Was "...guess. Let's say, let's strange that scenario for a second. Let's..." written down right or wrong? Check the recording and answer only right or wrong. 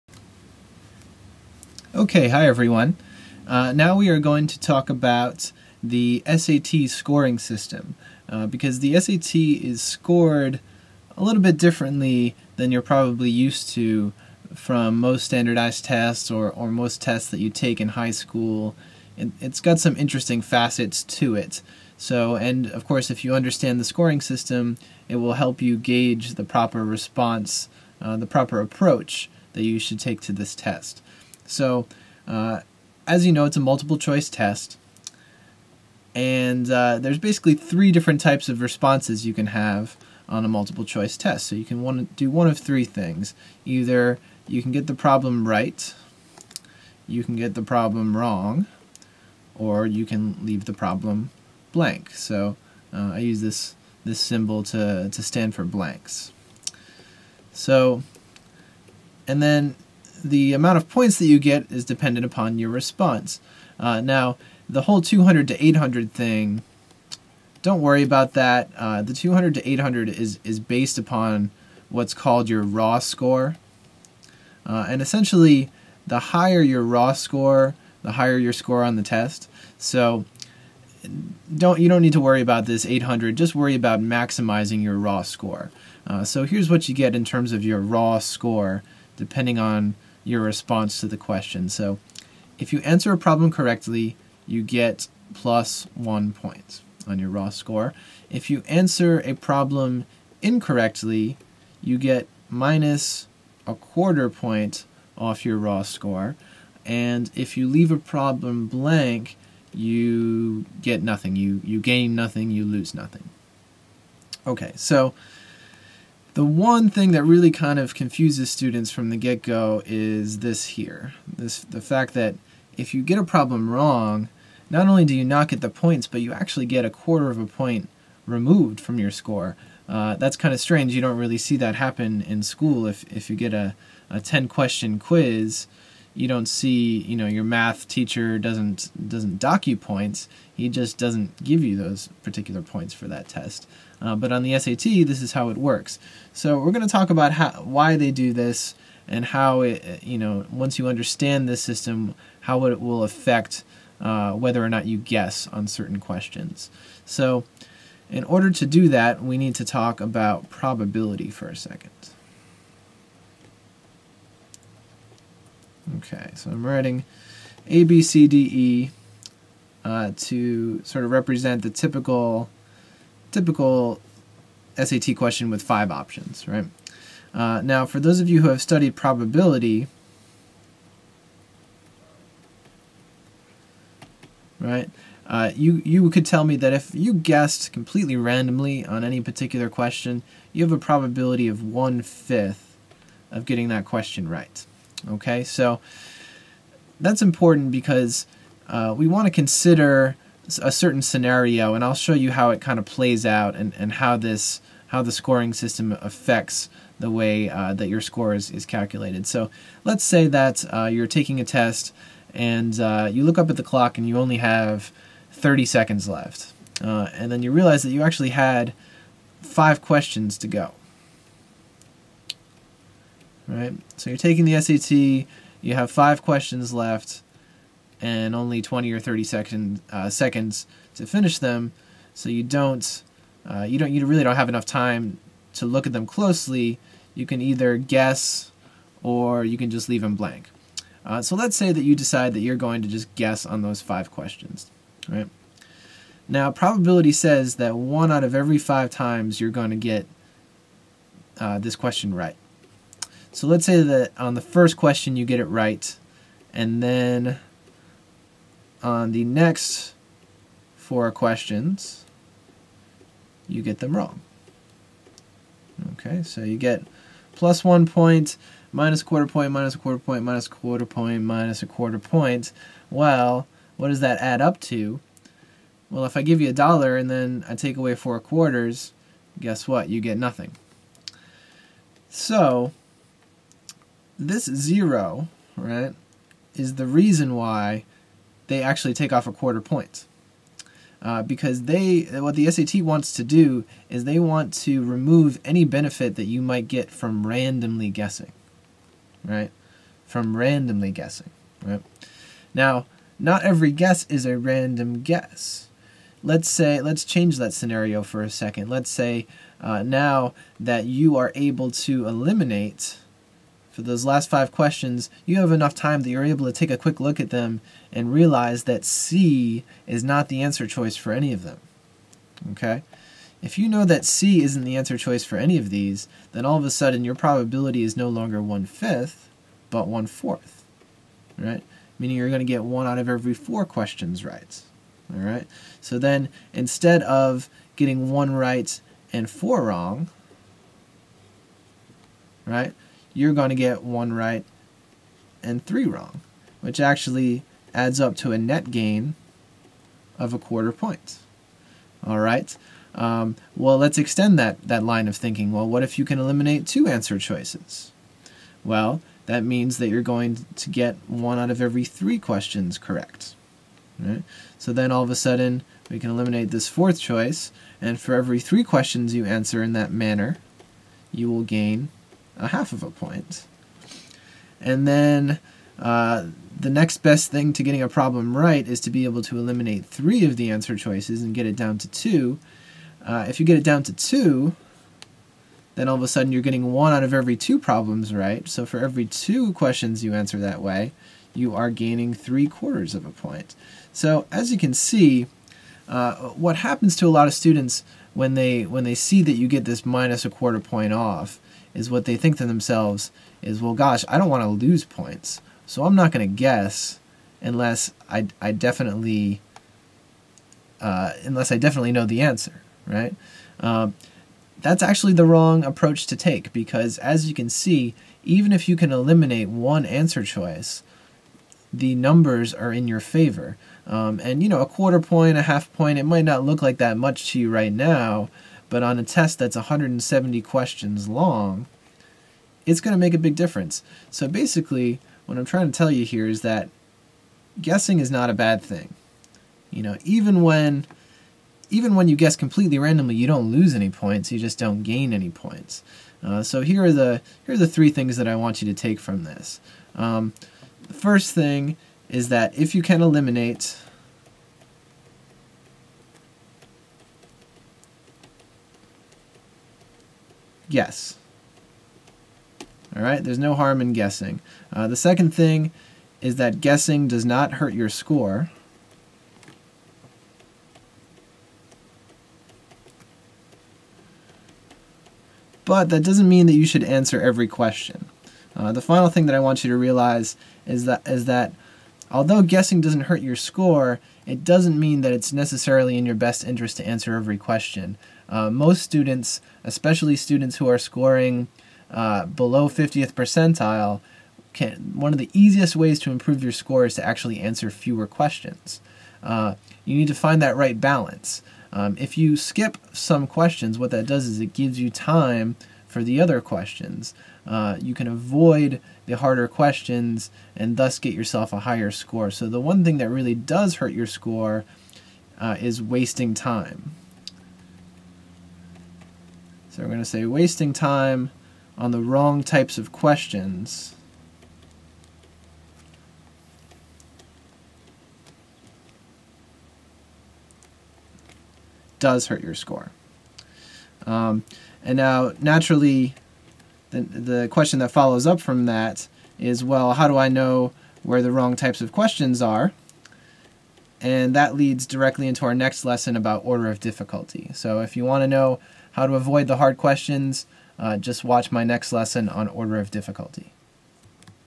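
wrong.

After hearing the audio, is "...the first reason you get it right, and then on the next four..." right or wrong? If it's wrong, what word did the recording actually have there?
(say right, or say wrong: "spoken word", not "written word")
wrong: "question", not "reason".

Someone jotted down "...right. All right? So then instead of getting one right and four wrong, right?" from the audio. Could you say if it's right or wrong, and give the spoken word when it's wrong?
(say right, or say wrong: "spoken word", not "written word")
right.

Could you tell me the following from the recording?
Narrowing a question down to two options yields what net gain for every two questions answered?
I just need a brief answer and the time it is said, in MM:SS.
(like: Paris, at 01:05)
three quarters of a point, at 06:32.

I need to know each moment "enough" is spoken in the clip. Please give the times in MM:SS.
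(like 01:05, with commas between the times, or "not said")
03:54, 05:15.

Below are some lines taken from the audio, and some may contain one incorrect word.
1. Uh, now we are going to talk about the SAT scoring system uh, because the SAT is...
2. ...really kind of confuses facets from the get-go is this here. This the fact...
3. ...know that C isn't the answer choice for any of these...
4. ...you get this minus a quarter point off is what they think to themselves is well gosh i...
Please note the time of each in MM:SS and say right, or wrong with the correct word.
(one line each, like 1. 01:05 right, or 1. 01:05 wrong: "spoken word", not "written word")
1. 00:03 right
2. 01:57 wrong: "students", not "facets"
3. 05:23 right
4. 06:39 right.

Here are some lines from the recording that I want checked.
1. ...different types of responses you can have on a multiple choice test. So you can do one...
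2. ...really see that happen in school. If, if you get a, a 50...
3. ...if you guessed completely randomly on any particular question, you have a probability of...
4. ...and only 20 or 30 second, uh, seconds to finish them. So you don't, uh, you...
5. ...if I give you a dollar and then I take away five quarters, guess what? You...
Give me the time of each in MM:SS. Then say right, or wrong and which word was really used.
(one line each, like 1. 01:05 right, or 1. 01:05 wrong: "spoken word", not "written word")
1. 00:37 right
2. 02:11 wrong: "10", not "50"
3. 03:06 right
4. 03:48 right
5. 04:36 wrong: "four", not "five".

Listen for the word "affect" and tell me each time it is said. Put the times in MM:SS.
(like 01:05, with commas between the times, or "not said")
02:33, 03:26.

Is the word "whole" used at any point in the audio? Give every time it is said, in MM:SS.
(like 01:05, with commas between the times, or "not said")
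01:04.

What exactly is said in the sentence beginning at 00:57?
So, and then the amount of points that you get is dependent upon your response.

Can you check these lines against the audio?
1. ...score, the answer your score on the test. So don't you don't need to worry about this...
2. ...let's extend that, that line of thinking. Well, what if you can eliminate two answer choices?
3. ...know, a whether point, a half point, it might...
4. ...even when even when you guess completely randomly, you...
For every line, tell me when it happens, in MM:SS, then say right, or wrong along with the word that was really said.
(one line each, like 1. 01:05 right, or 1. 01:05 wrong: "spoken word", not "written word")
1. 01:17 wrong: "higher", not "answer"
2. 05:53 right
3. 07:04 wrong: "quarter", not "whether"
4. 07:20 right.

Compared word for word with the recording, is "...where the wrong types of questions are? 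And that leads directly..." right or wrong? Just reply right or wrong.
right.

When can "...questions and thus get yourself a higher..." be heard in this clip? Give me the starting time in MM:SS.
08:29.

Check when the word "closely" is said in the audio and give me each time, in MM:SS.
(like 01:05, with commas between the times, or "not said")
03:56.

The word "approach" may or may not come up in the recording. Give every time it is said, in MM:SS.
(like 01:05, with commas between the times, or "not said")
00:28, 06:55.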